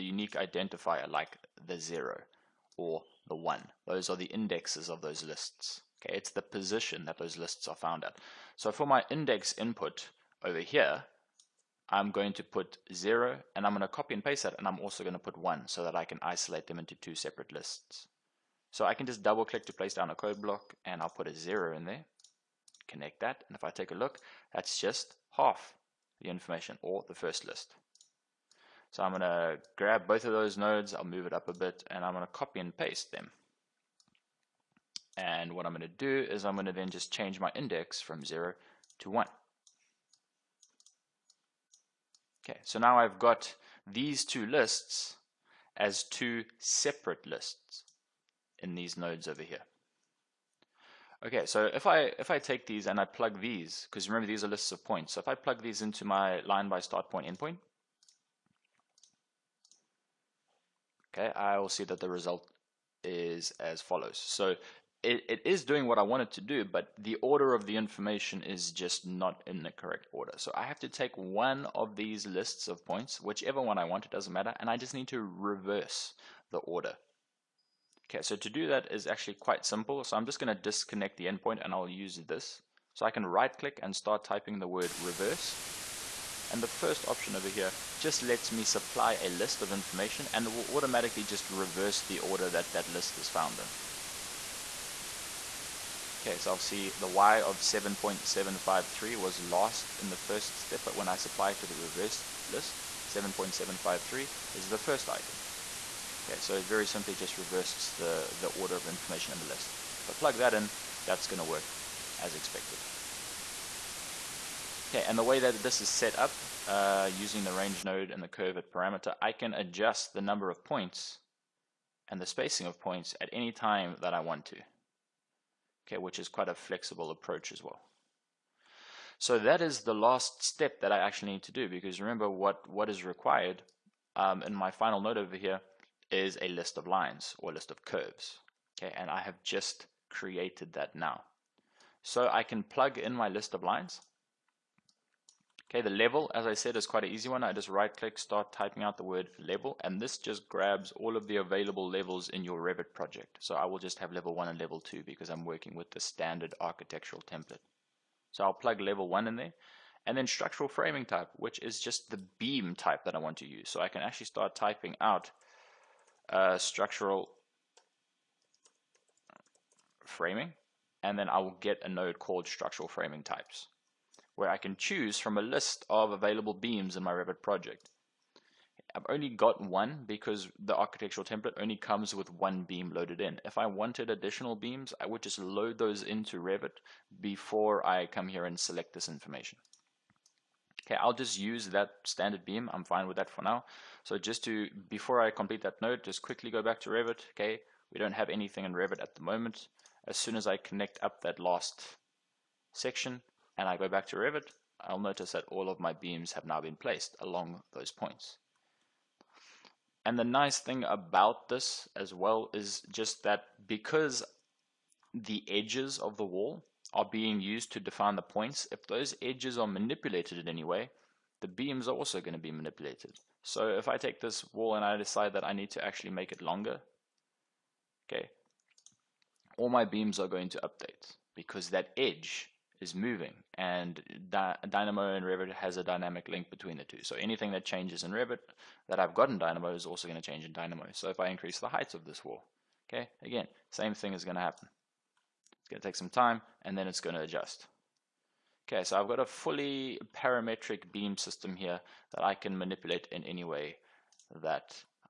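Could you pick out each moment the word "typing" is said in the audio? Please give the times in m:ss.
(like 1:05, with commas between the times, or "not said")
1:24, 2:28, 2:44.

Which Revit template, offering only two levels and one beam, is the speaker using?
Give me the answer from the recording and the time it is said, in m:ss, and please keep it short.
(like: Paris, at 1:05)
standard architectural template, at 2:35.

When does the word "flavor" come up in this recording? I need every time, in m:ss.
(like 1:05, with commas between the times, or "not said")
not said.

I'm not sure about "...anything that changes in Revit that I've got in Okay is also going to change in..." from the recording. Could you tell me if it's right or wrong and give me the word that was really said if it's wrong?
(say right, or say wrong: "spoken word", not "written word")
wrong: "Dynamo", not "Okay".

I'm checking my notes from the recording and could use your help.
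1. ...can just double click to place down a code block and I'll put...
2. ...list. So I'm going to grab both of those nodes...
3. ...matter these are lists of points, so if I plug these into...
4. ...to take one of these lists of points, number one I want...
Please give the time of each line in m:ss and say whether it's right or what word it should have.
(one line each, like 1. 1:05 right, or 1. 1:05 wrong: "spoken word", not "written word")
1. 0:18 right
2. 0:27 right
3. 0:54 wrong: "remember", not "matter"
4. 1:10 wrong: "whichever", not "number".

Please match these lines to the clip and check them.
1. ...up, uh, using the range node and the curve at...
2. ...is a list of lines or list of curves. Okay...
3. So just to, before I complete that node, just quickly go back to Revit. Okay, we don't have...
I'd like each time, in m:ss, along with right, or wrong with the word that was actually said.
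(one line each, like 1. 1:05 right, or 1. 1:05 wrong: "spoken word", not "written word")
1. 1:56 right
2. 2:16 right
3. 3:14 right.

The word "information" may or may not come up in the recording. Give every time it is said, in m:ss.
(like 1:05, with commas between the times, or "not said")
0:26, 1:07, 1:29, 1:48, 3:09.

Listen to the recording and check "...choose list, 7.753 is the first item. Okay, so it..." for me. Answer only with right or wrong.
wrong.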